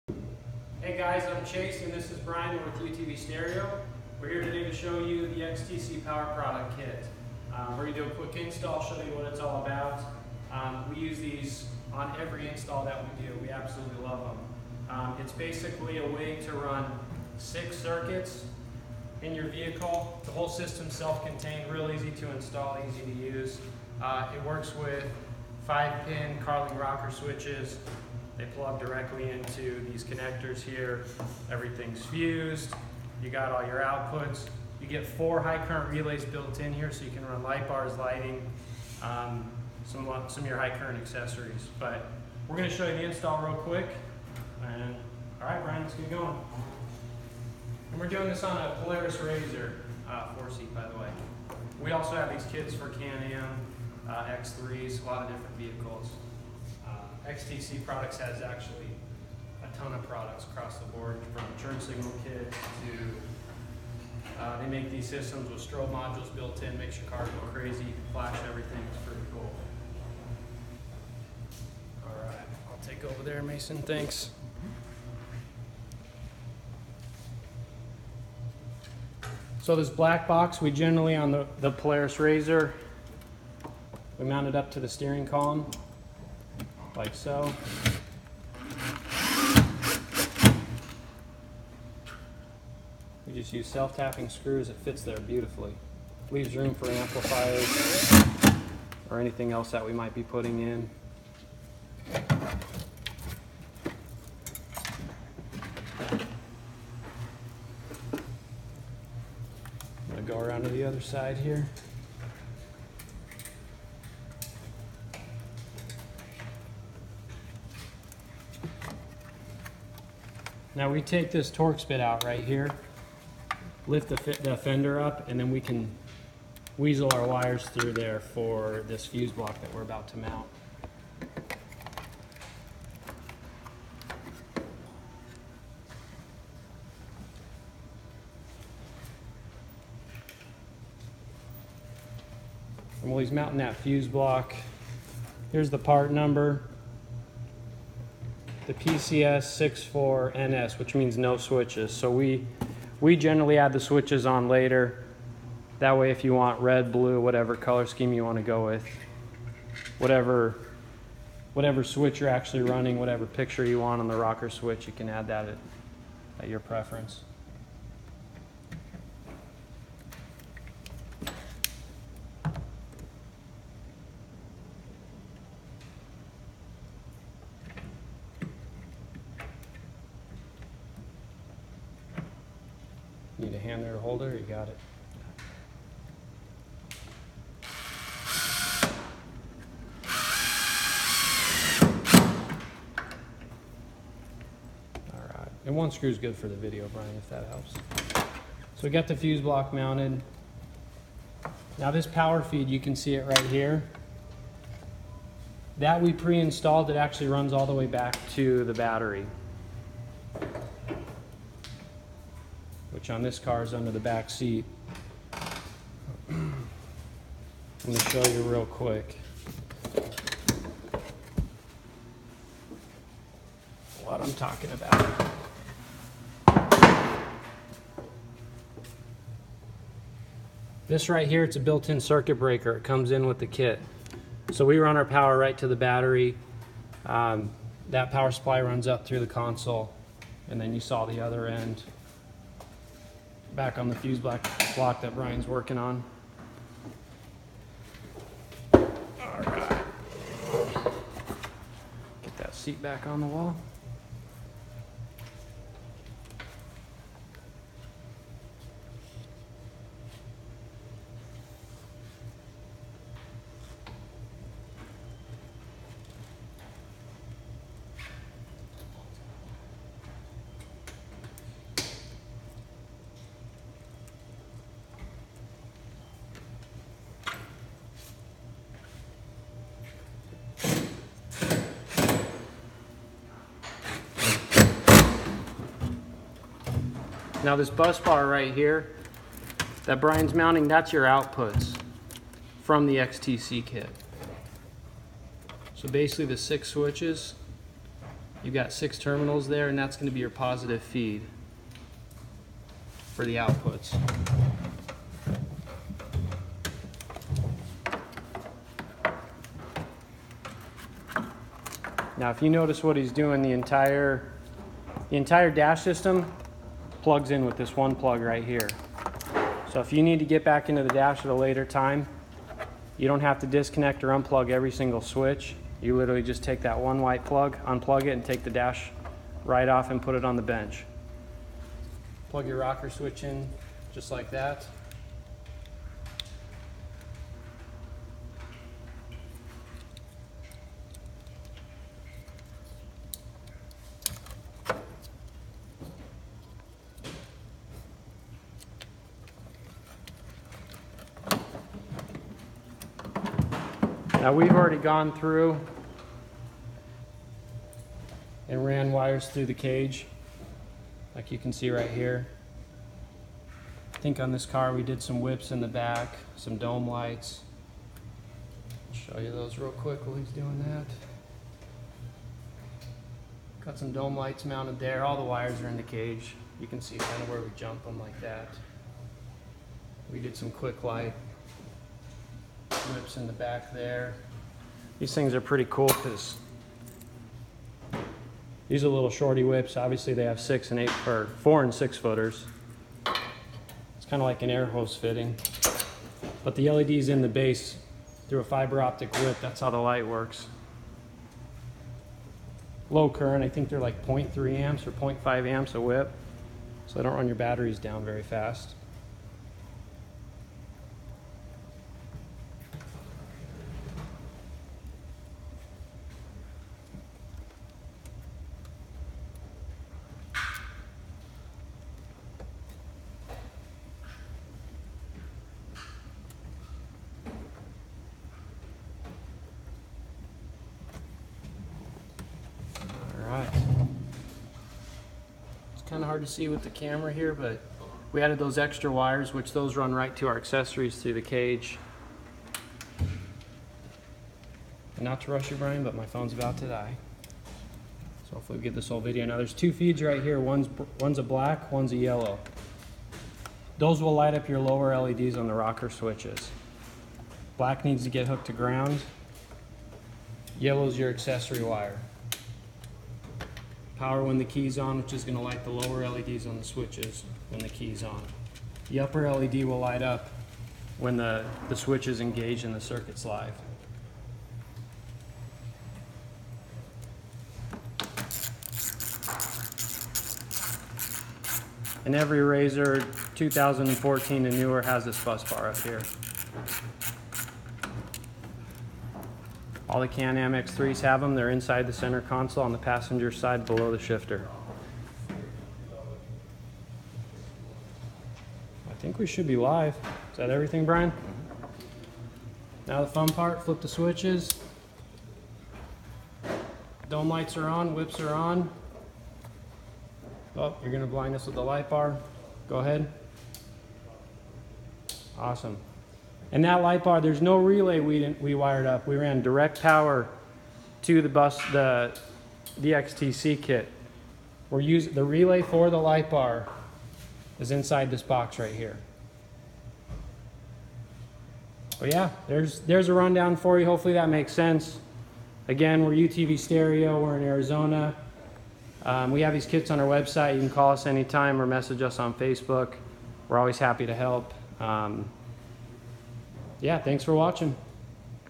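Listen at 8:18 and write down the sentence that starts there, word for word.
I think we should be live.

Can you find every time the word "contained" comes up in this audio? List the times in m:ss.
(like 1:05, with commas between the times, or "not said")
0:20.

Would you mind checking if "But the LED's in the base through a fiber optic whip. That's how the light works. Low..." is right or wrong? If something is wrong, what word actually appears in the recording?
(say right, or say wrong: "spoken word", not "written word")
right.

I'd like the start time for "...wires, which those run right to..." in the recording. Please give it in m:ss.
7:18.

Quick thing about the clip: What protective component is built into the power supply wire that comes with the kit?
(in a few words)
Circuit breaker.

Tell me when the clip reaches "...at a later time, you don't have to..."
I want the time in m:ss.
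5:21.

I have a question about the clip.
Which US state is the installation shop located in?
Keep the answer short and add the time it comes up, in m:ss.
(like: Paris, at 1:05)
Arizona, at 8:57.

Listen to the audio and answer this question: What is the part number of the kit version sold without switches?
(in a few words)
PCS 64NS.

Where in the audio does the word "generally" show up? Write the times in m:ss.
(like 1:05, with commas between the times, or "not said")
1:20, 2:33.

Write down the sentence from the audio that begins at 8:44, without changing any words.
We're using the relay for the light bar is inside this box right here.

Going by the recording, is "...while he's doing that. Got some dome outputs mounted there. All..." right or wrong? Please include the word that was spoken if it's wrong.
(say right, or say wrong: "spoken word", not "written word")
wrong: "lights", not "outputs".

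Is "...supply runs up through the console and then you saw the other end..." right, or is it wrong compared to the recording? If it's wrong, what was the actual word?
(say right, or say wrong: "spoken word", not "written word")
right.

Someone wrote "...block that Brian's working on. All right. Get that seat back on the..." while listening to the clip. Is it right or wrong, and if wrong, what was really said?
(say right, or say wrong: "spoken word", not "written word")
right.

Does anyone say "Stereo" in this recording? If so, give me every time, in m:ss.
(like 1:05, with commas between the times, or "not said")
0:03, 8:56.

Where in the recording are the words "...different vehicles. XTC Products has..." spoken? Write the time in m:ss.
0:55.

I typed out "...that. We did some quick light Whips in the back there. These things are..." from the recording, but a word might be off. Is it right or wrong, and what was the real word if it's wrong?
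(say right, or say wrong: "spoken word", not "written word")
right.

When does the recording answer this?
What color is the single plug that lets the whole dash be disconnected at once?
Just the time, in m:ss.
5:27.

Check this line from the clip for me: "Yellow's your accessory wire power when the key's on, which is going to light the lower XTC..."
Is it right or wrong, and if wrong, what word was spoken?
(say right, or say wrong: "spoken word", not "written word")
wrong: "LEDs", not "XTC".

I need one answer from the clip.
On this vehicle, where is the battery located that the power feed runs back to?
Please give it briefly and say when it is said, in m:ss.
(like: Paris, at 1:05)
Under the back seat, at 3:33.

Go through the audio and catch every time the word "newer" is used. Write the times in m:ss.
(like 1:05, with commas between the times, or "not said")
8:04.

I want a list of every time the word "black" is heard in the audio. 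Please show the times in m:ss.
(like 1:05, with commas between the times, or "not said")
1:19, 7:31, 7:37.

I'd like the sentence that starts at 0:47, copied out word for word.
And we're doing this on a Polaris RZR uh, four seat, by the way.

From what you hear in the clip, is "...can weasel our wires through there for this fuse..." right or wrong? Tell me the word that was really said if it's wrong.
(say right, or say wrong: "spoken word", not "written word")
right.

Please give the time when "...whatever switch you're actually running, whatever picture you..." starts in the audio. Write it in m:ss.
2:41.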